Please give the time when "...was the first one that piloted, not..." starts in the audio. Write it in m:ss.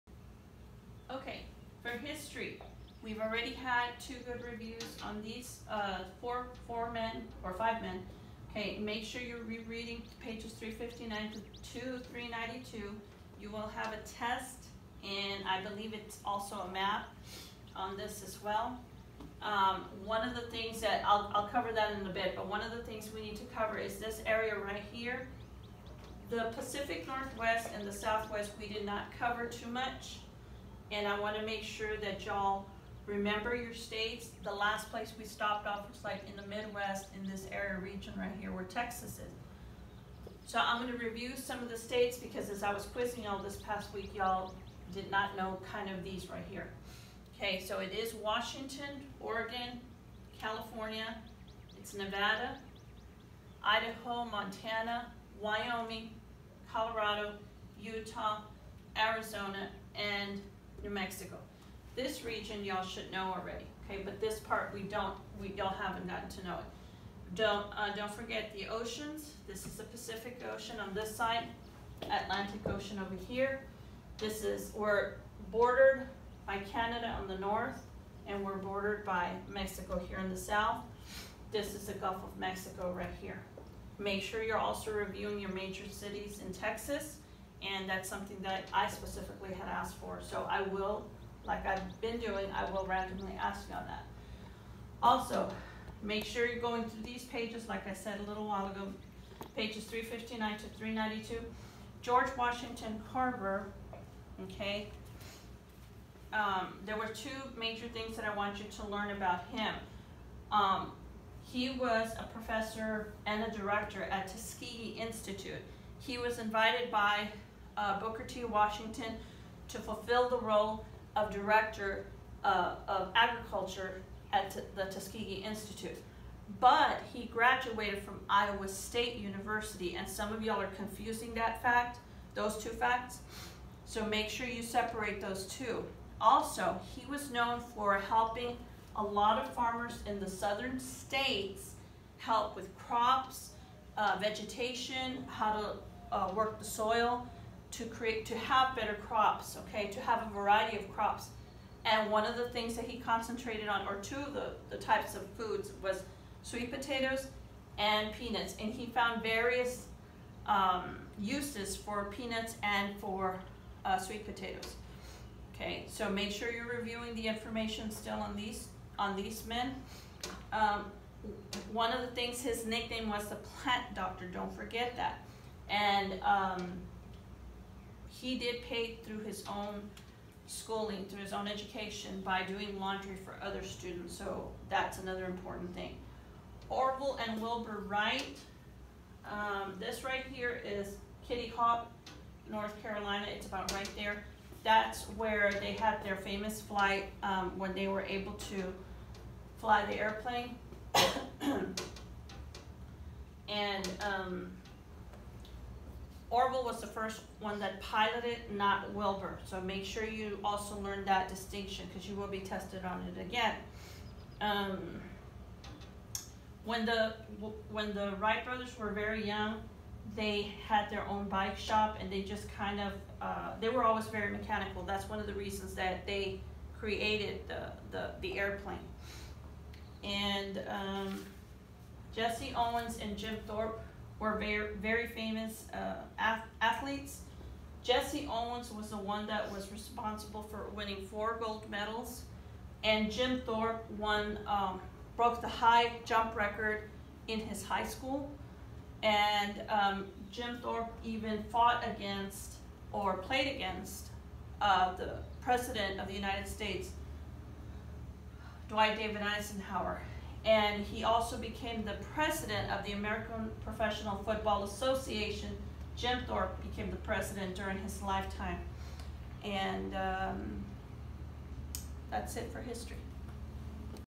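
3:26.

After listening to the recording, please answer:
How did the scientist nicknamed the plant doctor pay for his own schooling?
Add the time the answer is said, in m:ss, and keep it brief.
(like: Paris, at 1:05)
Doing laundry, at 3:02.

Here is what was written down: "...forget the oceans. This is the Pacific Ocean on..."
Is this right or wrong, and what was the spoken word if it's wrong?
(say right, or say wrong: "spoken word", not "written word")
right.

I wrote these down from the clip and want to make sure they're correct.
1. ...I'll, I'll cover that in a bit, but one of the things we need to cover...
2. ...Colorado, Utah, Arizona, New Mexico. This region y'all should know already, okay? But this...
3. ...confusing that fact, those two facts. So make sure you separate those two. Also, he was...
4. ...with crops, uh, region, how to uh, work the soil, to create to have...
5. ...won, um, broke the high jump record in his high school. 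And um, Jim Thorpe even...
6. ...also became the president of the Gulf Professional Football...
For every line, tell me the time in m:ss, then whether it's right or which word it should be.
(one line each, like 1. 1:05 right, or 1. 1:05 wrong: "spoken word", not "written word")
1. 0:21 right
2. 0:56 right
3. 2:10 right
4. 2:22 wrong: "vegetation", not "region"
5. 4:03 right
6. 4:21 wrong: "American", not "Gulf".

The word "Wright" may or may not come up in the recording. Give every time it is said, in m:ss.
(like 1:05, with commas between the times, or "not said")
3:07, 3:38.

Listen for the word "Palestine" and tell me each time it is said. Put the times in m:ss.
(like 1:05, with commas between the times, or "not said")
not said.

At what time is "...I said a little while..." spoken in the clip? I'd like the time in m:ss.
1:37.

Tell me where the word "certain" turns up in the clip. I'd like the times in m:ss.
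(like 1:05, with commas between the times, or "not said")
not said.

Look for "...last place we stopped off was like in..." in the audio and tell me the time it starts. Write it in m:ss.
0:34.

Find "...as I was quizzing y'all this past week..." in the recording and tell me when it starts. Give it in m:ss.
0:42.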